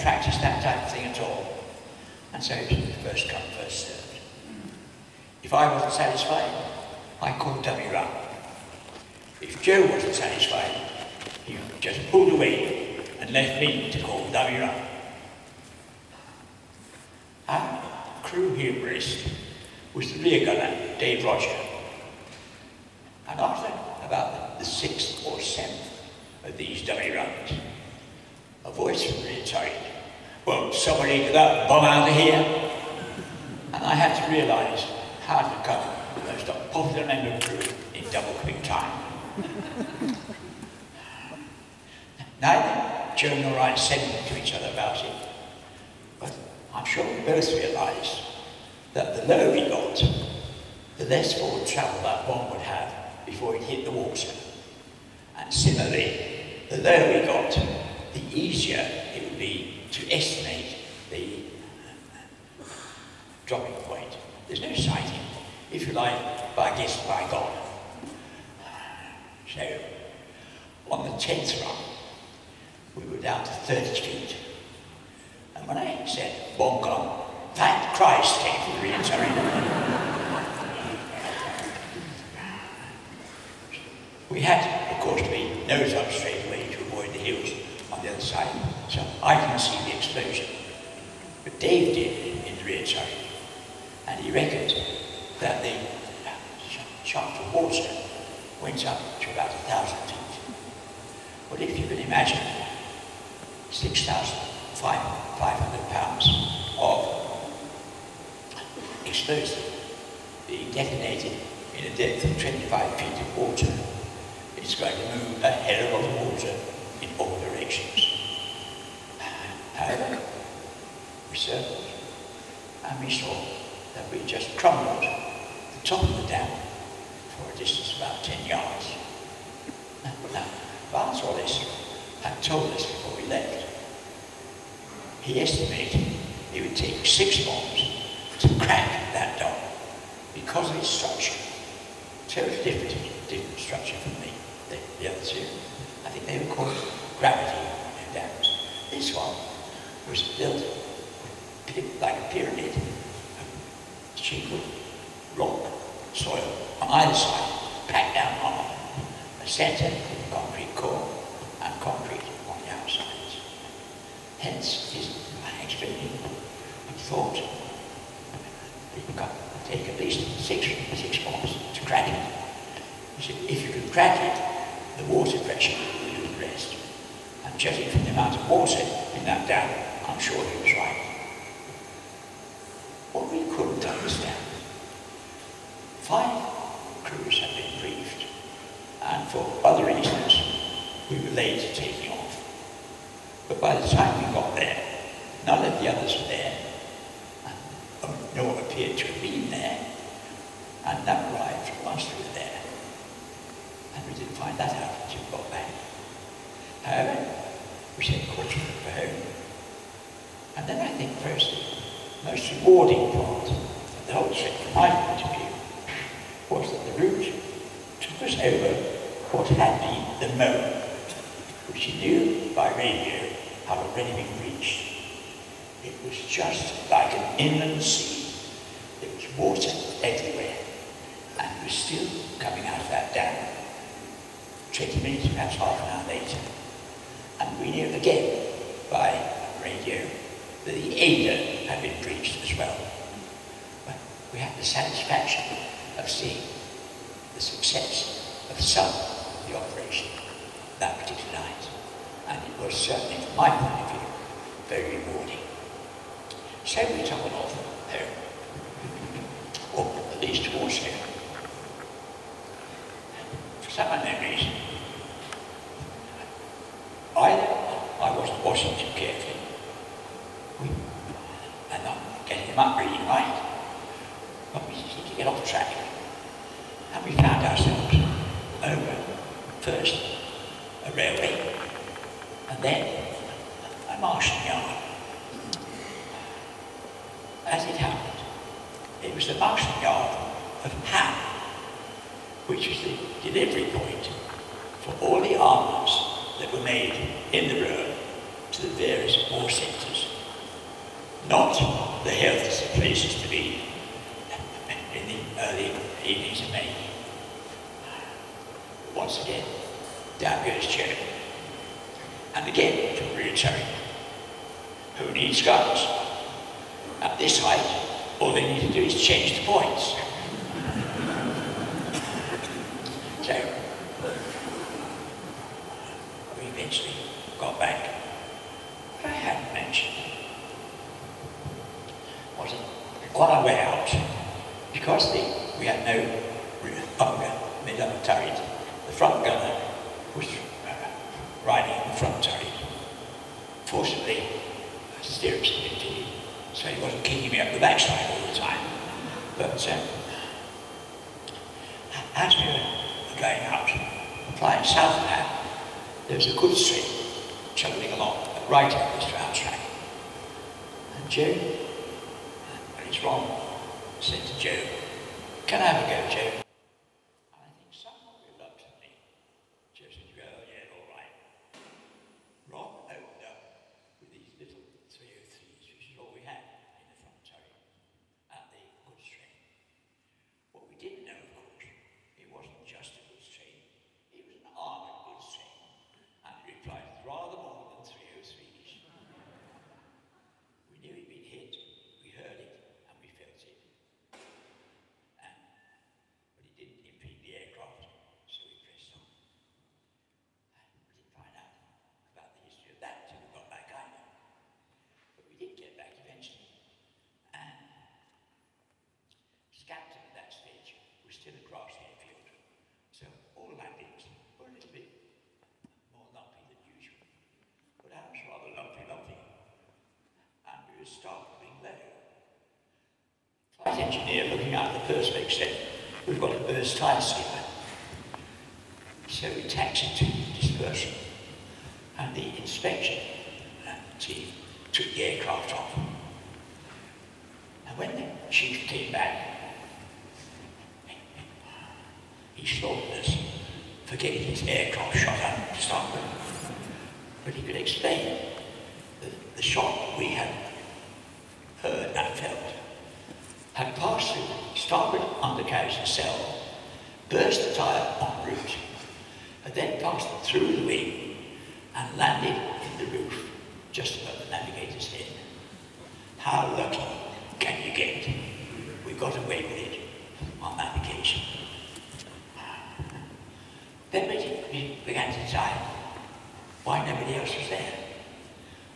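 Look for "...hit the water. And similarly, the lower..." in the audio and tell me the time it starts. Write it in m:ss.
0:53.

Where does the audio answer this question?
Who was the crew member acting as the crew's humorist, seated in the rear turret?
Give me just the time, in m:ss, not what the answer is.
0:20.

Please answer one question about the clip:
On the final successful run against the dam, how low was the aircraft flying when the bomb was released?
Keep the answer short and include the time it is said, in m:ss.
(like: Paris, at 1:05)
30 feet, at 1:13.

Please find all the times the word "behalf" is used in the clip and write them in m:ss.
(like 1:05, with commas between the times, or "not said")
not said.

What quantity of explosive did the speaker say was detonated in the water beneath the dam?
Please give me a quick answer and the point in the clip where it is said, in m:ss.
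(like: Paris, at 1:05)
6,500 pounds, at 1:43.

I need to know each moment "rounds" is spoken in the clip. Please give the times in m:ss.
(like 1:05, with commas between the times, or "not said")
0:27, 5:59.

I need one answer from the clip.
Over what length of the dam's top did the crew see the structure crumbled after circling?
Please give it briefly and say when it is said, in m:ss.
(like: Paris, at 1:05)
about 10 yards, at 2:08.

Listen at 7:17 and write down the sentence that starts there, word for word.
And when the chief came back, he slaughtered us for getting his aircraft shot up to start with.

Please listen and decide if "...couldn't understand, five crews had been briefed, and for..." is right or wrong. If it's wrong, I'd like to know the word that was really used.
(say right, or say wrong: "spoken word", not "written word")
right.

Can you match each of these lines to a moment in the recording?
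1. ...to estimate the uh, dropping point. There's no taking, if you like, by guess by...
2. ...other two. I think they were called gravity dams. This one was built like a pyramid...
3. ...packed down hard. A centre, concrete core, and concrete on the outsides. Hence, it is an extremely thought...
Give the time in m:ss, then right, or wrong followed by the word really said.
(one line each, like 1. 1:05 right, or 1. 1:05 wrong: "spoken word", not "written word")
1. 0:59 wrong: "sighting", not "taking"
2. 2:25 right
3. 2:37 right.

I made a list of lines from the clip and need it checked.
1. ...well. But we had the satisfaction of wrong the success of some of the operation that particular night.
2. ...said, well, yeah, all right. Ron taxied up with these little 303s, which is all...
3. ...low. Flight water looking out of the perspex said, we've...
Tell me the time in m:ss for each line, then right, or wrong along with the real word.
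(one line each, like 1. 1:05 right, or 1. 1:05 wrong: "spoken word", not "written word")
1. 4:02 wrong: "seeing", not "wrong"
2. 6:09 wrong: "opened", not "taxied"
3. 7:01 wrong: "engineer", not "water".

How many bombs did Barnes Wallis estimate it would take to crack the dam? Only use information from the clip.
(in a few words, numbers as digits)
6.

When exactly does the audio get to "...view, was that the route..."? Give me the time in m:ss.
3:35.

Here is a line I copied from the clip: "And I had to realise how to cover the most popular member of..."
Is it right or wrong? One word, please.
right.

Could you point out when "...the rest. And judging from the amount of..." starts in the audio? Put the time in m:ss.
2:56.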